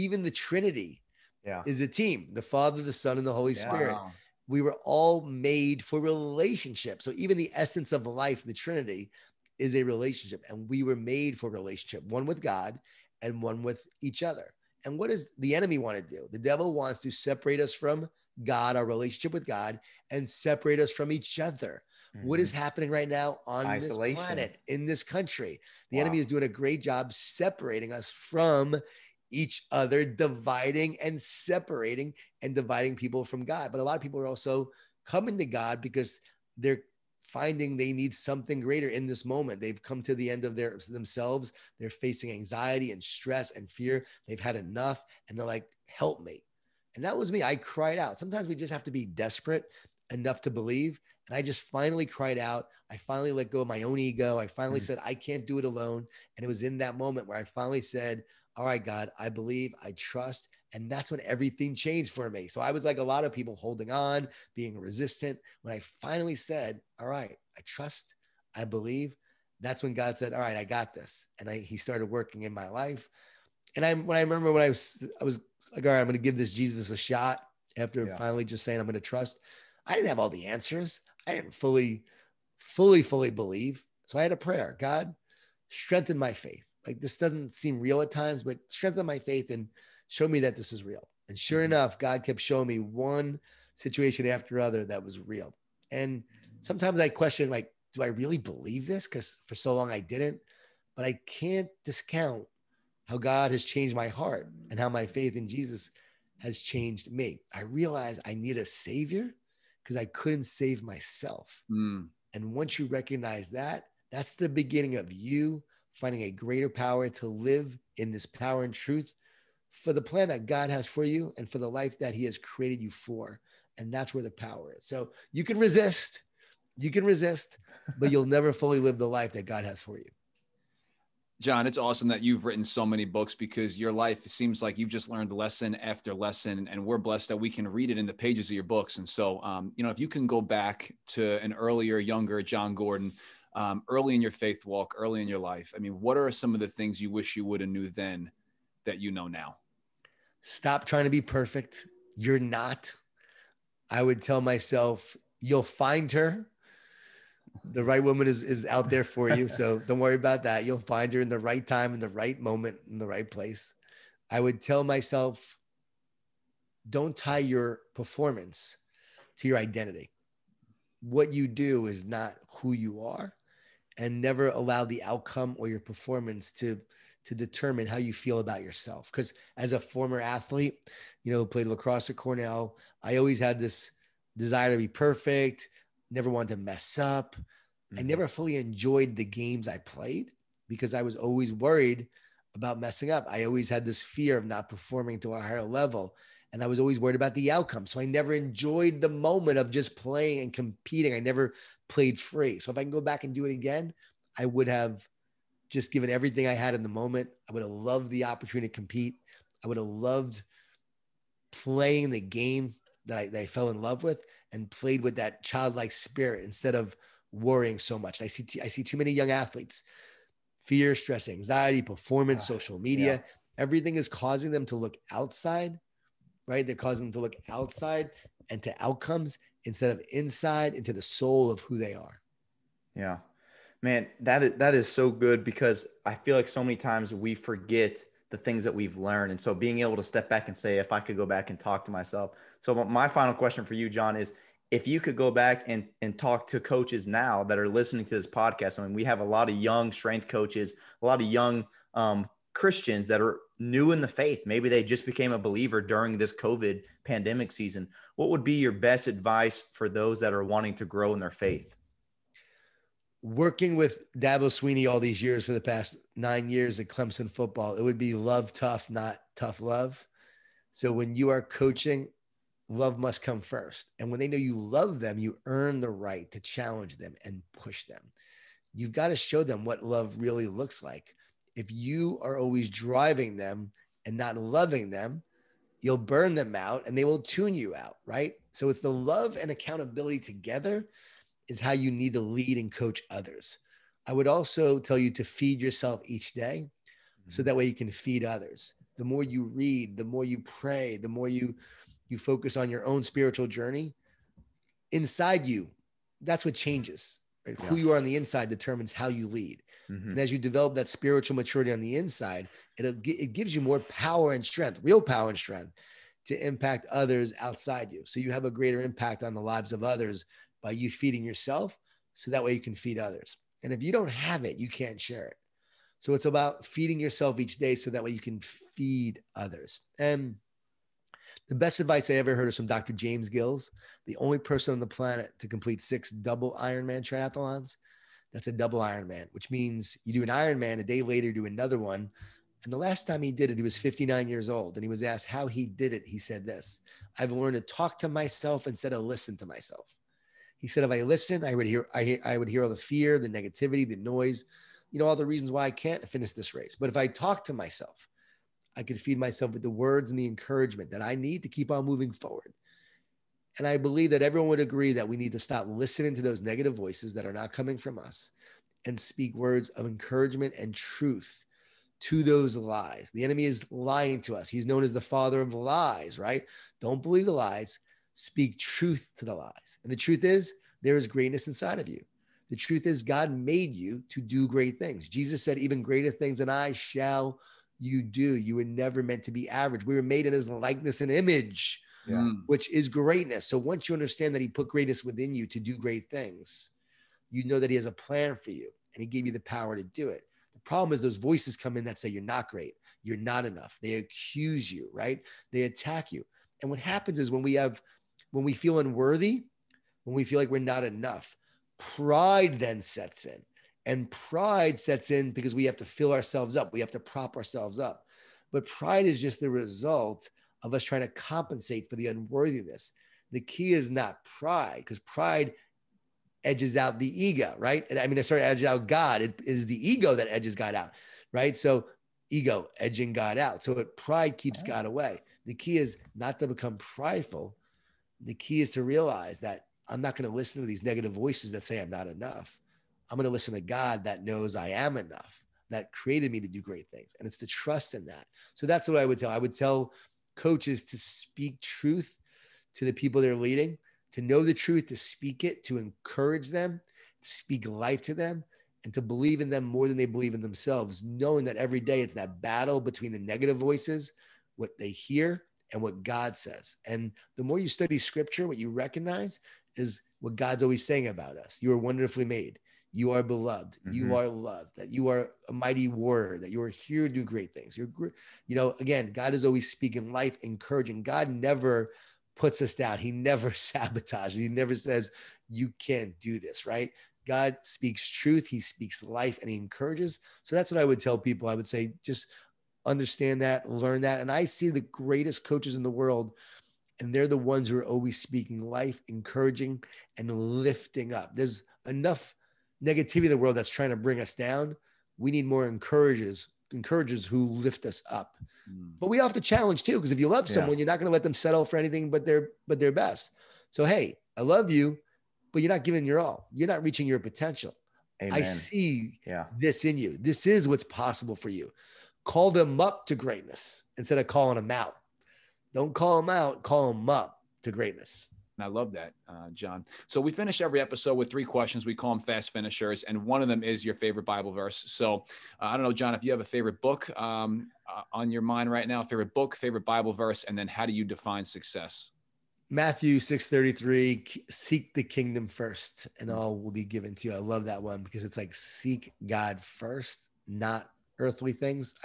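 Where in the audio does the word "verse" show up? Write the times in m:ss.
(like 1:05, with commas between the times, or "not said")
8:54, 9:00.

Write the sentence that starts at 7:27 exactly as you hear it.
And it's to trust in that.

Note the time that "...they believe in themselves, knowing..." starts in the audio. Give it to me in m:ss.
7:39.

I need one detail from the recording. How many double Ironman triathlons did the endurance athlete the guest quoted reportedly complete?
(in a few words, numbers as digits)
6.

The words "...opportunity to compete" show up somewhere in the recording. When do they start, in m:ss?
3:28.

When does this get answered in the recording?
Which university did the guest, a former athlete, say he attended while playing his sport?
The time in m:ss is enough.
3:02.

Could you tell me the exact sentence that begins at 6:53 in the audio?
And pride sets in because we have to fill ourselves up, we have to prop ourselves up.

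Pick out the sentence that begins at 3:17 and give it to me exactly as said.
So I never enjoyed the moment of just playing and competing.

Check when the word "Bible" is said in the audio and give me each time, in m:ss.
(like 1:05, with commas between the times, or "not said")
8:54, 8:59.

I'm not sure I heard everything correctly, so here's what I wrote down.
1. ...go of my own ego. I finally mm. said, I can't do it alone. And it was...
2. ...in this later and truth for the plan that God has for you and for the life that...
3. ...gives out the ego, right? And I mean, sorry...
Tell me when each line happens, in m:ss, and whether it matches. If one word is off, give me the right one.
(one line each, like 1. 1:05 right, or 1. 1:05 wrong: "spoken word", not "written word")
1. 0:53 right
2. 1:57 wrong: "power", not "later"
3. 7:06 wrong: "edges", not "gives".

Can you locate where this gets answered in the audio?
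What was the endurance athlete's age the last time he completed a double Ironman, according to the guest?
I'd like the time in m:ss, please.
5:43.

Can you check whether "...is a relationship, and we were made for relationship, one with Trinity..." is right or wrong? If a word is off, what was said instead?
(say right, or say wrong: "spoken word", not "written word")
wrong: "God", not "Trinity".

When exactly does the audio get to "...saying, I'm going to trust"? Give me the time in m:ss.
1:18.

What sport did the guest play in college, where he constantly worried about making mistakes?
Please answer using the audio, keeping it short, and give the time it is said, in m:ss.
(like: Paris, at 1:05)
Lacrosse, at 3:01.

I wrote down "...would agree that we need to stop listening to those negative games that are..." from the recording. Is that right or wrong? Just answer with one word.
wrong.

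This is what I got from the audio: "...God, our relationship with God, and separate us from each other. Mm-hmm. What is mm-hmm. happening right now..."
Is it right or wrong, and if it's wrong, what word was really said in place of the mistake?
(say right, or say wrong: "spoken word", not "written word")
right.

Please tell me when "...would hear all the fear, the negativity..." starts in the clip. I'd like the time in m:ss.
5:52.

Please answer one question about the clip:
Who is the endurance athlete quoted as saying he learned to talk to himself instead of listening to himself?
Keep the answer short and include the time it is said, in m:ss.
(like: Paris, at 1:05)
Dr. James Gills, at 5:32.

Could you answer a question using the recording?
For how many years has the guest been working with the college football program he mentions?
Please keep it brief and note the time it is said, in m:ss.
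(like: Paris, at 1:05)
9, at 4:26.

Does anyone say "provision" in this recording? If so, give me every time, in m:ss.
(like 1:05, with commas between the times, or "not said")
not said.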